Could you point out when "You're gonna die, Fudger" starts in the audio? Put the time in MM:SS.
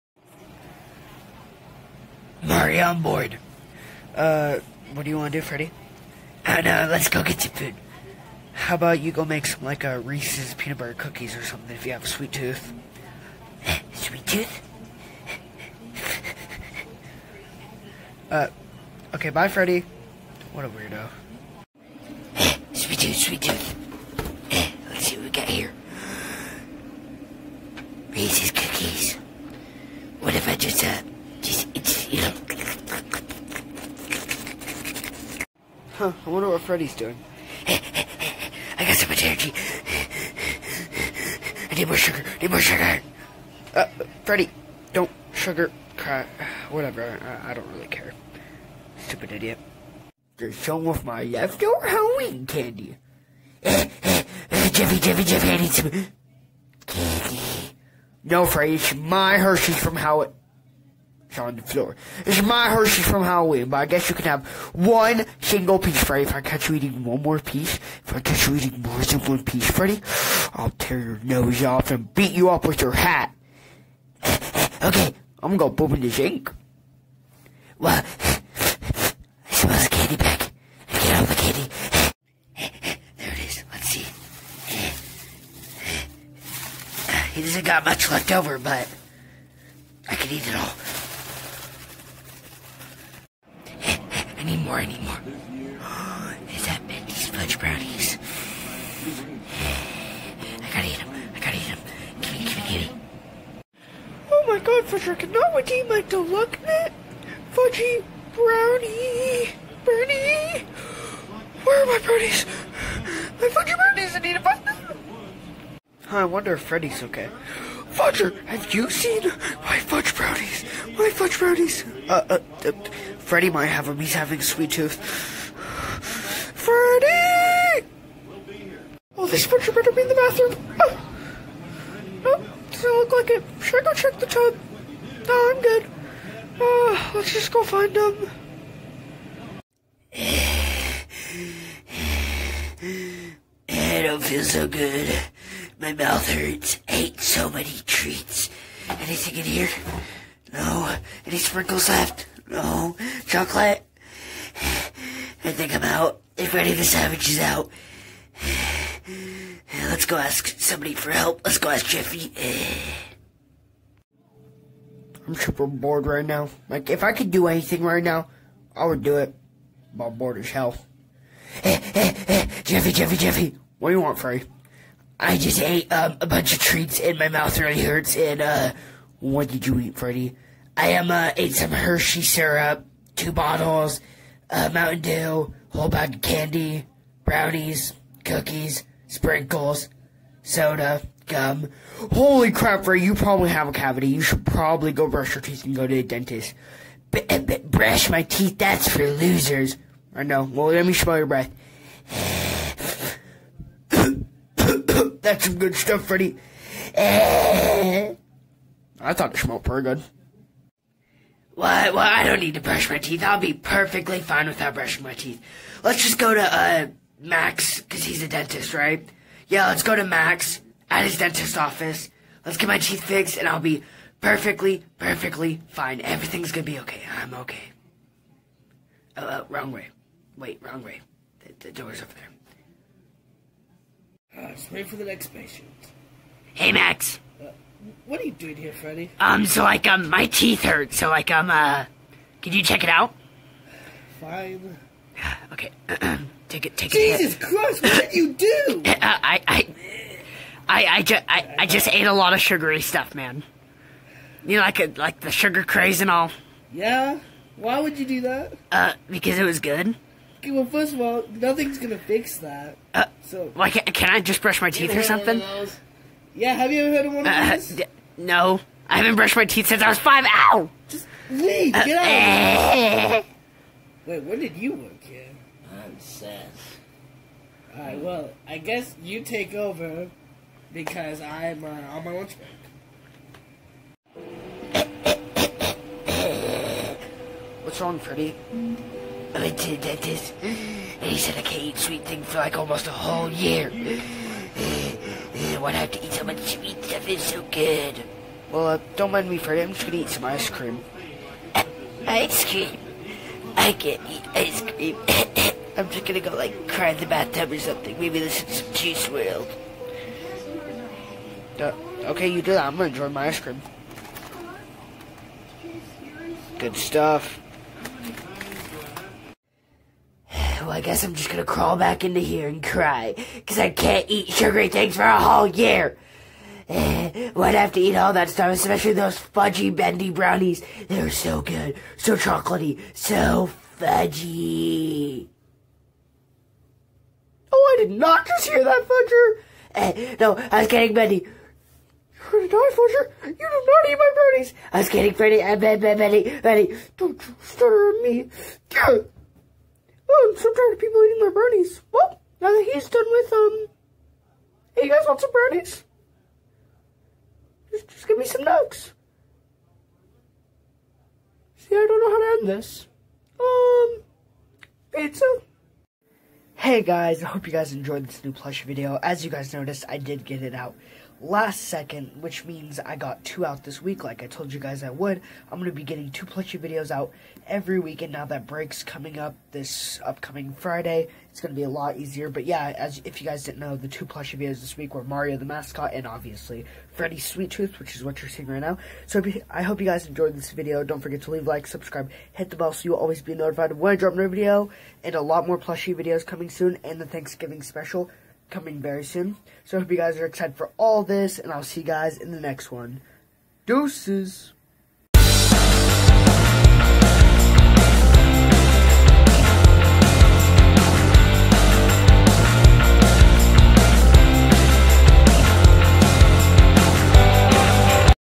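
05:42.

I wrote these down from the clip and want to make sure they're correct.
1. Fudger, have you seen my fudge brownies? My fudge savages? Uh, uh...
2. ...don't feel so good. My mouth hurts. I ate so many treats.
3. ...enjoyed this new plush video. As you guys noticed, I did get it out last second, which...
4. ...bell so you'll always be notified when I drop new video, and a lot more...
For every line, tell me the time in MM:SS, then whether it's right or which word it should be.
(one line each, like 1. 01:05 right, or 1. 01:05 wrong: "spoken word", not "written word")
1. 01:57 wrong: "brownies", not "savages"
2. 02:24 right
3. 06:07 right
4. 06:32 right.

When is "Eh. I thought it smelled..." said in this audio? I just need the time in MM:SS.
03:26.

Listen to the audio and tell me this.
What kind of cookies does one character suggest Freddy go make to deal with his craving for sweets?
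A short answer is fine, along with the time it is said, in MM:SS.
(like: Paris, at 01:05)
Reese's peanut butter cookies, at 00:10.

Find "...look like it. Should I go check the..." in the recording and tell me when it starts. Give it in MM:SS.
02:12.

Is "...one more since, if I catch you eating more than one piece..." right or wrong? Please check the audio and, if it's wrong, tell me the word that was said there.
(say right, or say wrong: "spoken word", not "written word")
wrong: "piece", not "since".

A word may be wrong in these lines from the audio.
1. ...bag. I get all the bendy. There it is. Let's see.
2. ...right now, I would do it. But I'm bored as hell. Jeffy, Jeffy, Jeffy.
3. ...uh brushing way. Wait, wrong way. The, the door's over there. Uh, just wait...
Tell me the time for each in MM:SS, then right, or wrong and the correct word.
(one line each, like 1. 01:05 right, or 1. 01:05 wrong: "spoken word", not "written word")
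1. 01:20 wrong: "candy", not "bendy"
2. 02:47 right
3. 03:49 wrong: "wrong", not "brushing".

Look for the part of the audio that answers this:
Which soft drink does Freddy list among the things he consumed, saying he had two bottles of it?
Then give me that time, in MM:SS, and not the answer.
03:04.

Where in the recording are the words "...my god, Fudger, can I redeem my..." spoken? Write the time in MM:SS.
01:44.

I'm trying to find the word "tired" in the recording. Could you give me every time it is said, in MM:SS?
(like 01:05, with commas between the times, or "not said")
05:50.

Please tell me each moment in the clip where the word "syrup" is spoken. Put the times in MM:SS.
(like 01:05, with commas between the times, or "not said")
03:02.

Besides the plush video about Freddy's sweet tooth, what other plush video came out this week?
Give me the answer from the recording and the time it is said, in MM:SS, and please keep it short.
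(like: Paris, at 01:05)
Mario the Mascot, at 06:25.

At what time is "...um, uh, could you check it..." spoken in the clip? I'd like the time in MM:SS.
04:01.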